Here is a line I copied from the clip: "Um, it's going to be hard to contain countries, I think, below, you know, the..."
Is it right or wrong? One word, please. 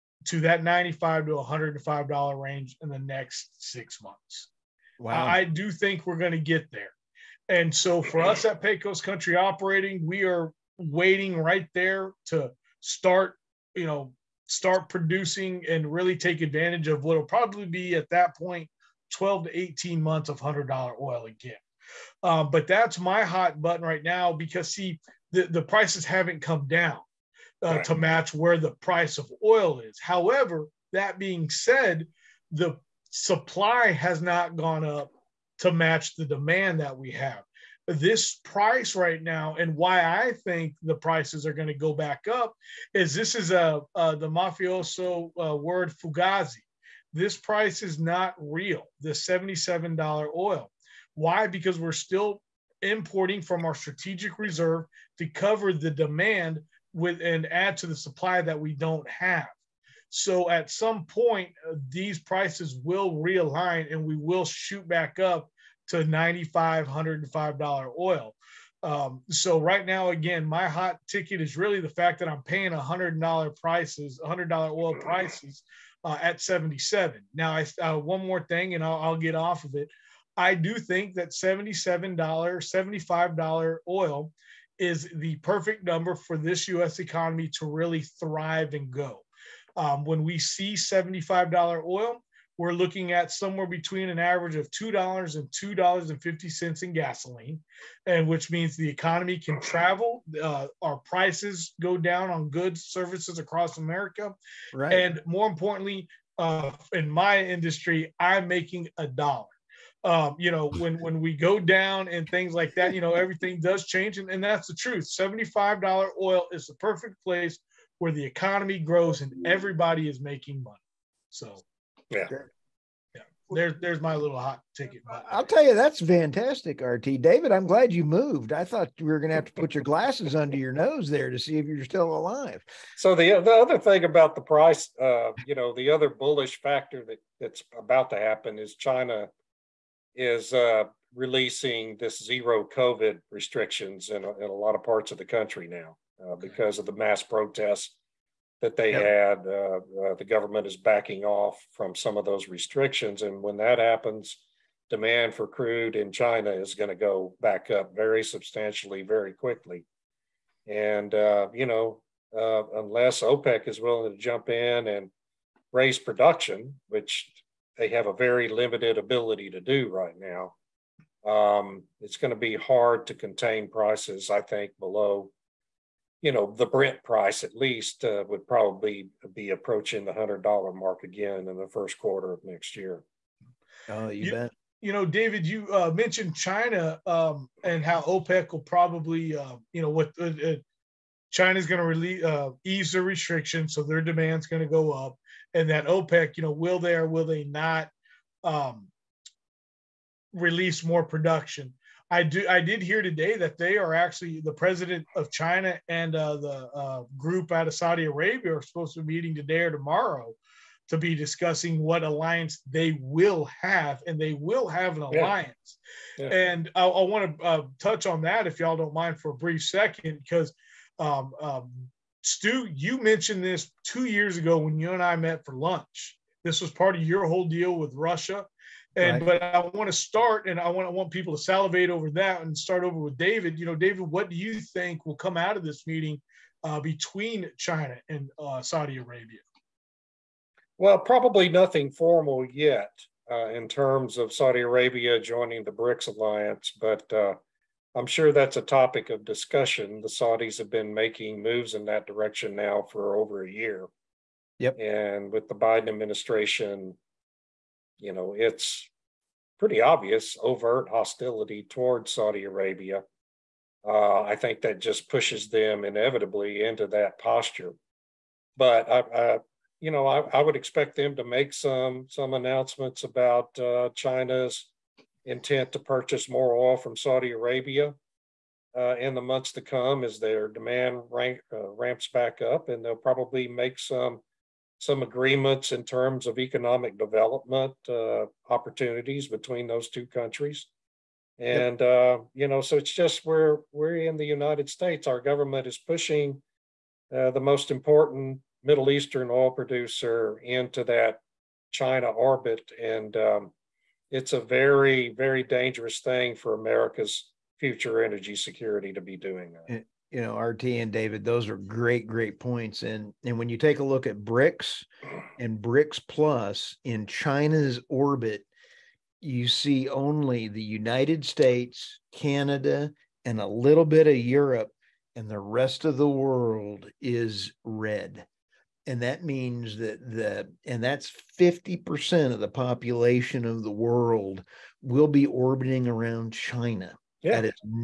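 wrong.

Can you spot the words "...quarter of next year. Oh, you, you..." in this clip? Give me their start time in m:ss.
3:01.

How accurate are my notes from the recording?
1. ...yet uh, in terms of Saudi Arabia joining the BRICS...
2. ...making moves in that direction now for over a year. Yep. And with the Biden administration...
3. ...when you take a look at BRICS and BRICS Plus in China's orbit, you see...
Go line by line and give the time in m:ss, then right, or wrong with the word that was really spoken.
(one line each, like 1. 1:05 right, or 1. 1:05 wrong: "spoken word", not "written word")
1. 4:02 right
2. 4:10 right
3. 5:13 right.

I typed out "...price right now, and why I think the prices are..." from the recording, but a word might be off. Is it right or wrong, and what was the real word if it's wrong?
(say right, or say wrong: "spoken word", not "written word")
right.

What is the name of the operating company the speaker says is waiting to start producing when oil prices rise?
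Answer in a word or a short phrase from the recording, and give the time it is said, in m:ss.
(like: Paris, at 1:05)
Pecos Country Operating, at 0:08.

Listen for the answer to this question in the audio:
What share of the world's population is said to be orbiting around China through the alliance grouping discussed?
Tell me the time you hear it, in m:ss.
5:31.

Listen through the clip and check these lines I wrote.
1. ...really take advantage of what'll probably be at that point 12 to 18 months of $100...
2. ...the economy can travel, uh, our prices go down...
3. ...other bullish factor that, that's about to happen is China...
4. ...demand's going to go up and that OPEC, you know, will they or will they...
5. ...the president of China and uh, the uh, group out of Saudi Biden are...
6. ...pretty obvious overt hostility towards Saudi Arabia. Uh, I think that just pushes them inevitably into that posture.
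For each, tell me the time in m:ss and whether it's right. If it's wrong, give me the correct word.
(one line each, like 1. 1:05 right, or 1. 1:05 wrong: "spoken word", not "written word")
1. 0:15 right
2. 1:38 right
3. 2:15 right
4. 3:14 right
5. 3:24 wrong: "Arabia", not "Biden"
6. 4:19 right.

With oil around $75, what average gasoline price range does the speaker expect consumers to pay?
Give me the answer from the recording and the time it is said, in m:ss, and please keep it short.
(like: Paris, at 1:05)
$2 to $2.50, at 1:34.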